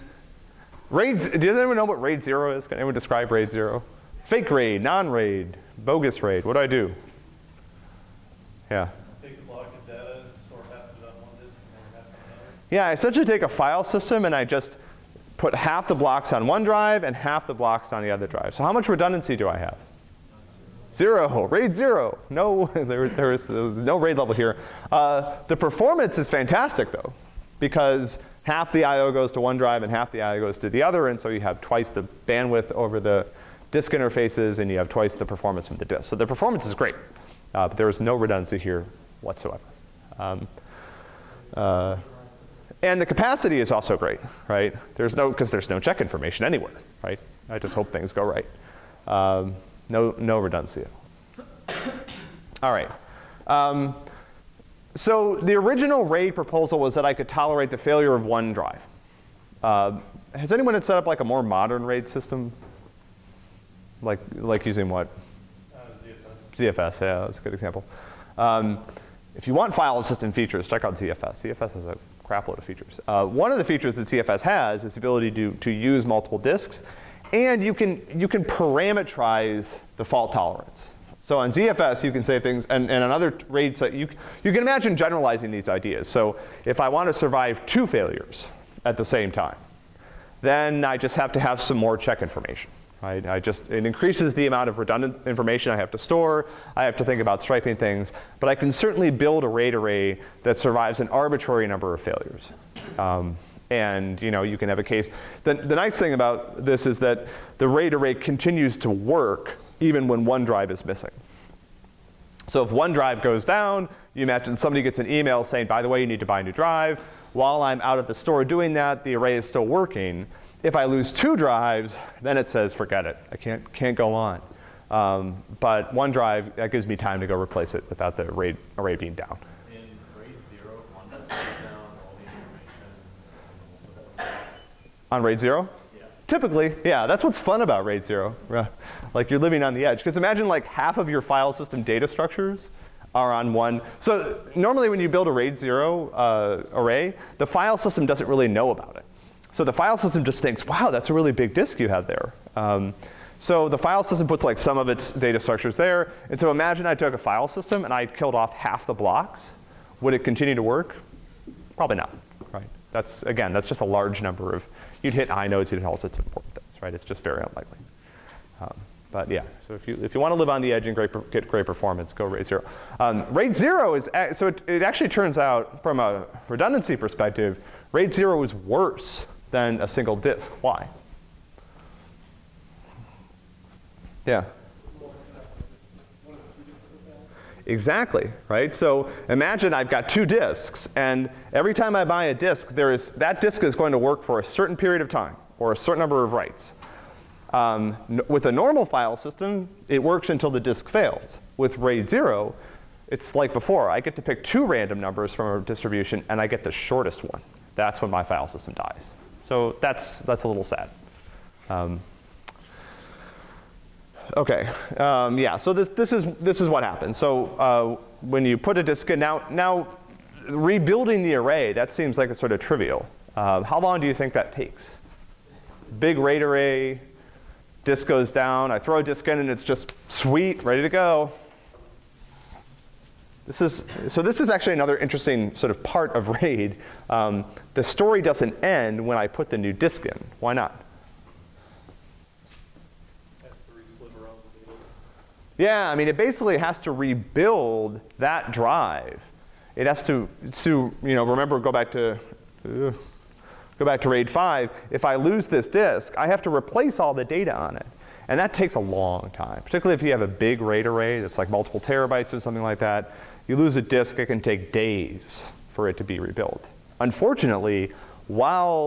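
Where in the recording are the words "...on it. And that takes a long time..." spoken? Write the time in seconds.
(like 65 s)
257 s.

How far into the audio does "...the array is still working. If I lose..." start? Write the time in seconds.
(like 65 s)
119 s.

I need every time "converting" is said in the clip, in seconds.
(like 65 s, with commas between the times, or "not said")
not said.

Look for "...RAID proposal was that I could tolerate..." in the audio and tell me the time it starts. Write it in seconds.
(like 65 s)
56 s.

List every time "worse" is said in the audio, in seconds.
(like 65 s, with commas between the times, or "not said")
178 s.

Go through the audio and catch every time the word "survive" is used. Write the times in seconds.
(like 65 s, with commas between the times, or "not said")
87 s, 100 s.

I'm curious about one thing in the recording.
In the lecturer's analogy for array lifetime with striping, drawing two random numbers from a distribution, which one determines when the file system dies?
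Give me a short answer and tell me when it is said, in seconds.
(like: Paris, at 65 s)
The shortest one, at 206 s.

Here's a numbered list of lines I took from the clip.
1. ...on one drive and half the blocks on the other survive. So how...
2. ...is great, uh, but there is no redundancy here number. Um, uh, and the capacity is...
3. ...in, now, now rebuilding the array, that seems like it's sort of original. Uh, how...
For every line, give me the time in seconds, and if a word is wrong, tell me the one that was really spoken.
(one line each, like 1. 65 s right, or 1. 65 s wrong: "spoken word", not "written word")
1. 16 s wrong: "drive", not "survive"
2. 36 s wrong: "whatsoever", not "number"
3. 219 s wrong: "trivial", not "original".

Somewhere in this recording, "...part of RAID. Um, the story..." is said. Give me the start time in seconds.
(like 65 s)
235 s.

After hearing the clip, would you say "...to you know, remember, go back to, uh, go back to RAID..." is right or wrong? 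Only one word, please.
right.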